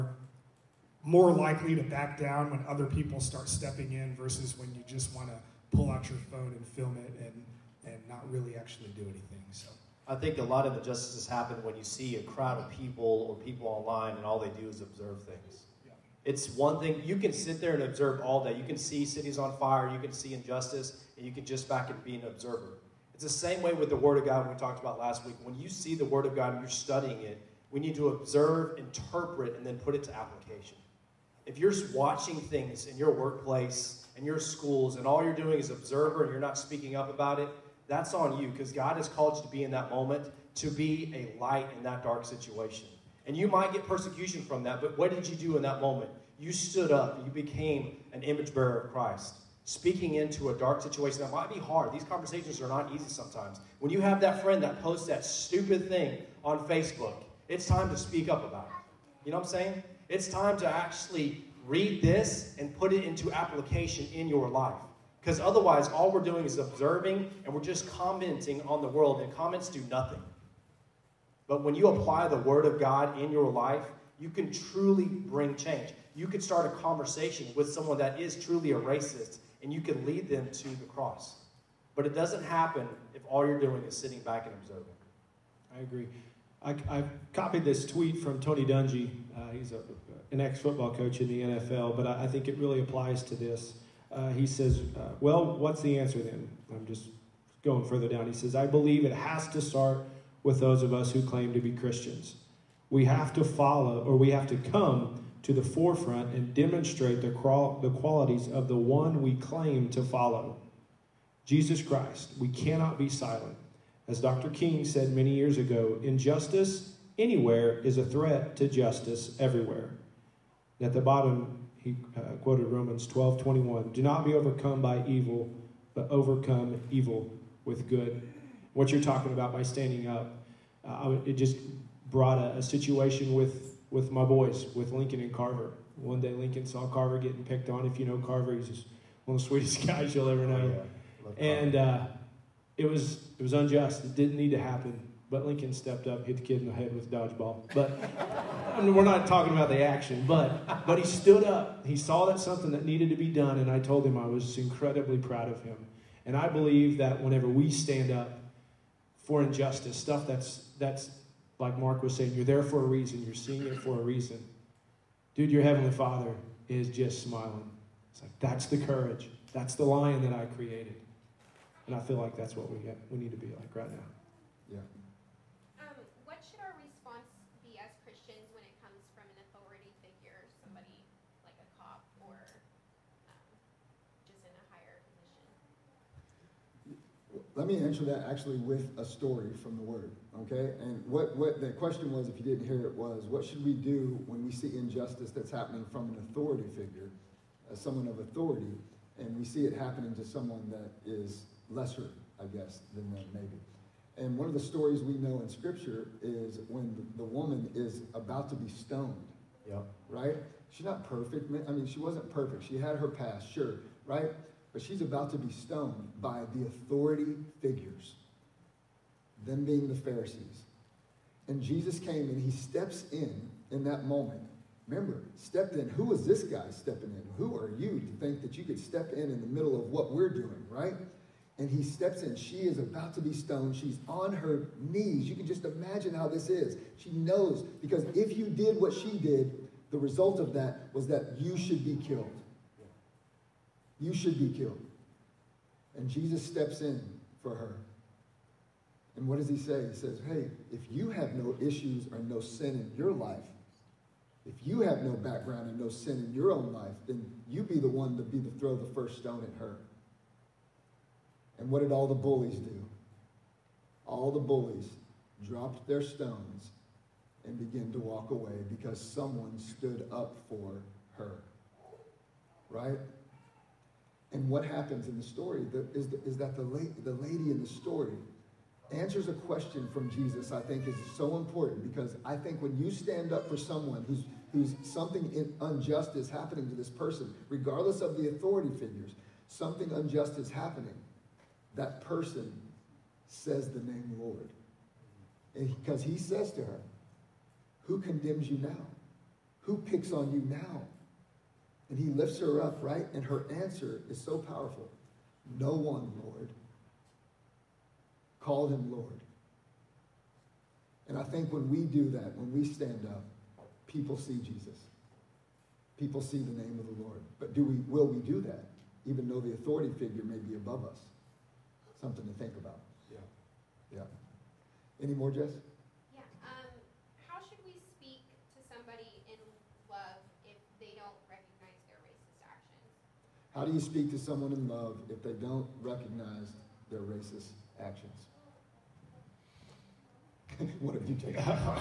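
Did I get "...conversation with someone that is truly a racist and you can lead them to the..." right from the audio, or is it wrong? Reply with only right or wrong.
right.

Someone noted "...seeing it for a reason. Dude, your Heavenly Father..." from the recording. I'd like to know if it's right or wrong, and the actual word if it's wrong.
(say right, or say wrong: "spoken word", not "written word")
right.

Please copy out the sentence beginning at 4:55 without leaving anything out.
Because he says to her, Who condemns you now?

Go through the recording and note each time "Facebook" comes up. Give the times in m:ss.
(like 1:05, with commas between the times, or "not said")
0:56.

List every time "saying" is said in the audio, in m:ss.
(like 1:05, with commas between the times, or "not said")
0:59, 2:42.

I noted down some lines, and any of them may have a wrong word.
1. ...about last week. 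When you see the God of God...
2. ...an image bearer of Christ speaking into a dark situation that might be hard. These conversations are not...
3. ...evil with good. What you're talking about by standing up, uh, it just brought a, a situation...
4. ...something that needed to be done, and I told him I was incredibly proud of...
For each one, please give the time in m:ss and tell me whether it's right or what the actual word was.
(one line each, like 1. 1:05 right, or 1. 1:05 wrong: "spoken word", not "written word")
1. 0:24 wrong: "Word", not "God"
2. 0:48 right
3. 2:06 right
4. 2:32 right.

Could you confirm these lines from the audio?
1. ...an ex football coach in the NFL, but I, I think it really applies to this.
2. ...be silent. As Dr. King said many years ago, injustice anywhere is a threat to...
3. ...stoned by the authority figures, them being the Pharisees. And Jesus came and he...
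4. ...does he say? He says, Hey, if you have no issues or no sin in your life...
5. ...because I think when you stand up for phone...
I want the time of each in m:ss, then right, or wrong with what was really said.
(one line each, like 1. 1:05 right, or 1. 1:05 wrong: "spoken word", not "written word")
1. 1:30 right
2. 1:52 right
3. 3:35 right
4. 4:09 right
5. 4:41 wrong: "someone", not "phone".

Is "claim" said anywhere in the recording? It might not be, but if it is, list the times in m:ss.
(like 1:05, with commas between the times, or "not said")
1:41, 1:49.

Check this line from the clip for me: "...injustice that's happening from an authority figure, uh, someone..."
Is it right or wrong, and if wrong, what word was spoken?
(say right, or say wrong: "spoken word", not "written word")
right.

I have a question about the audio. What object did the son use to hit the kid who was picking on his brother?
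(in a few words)
Dodgeball.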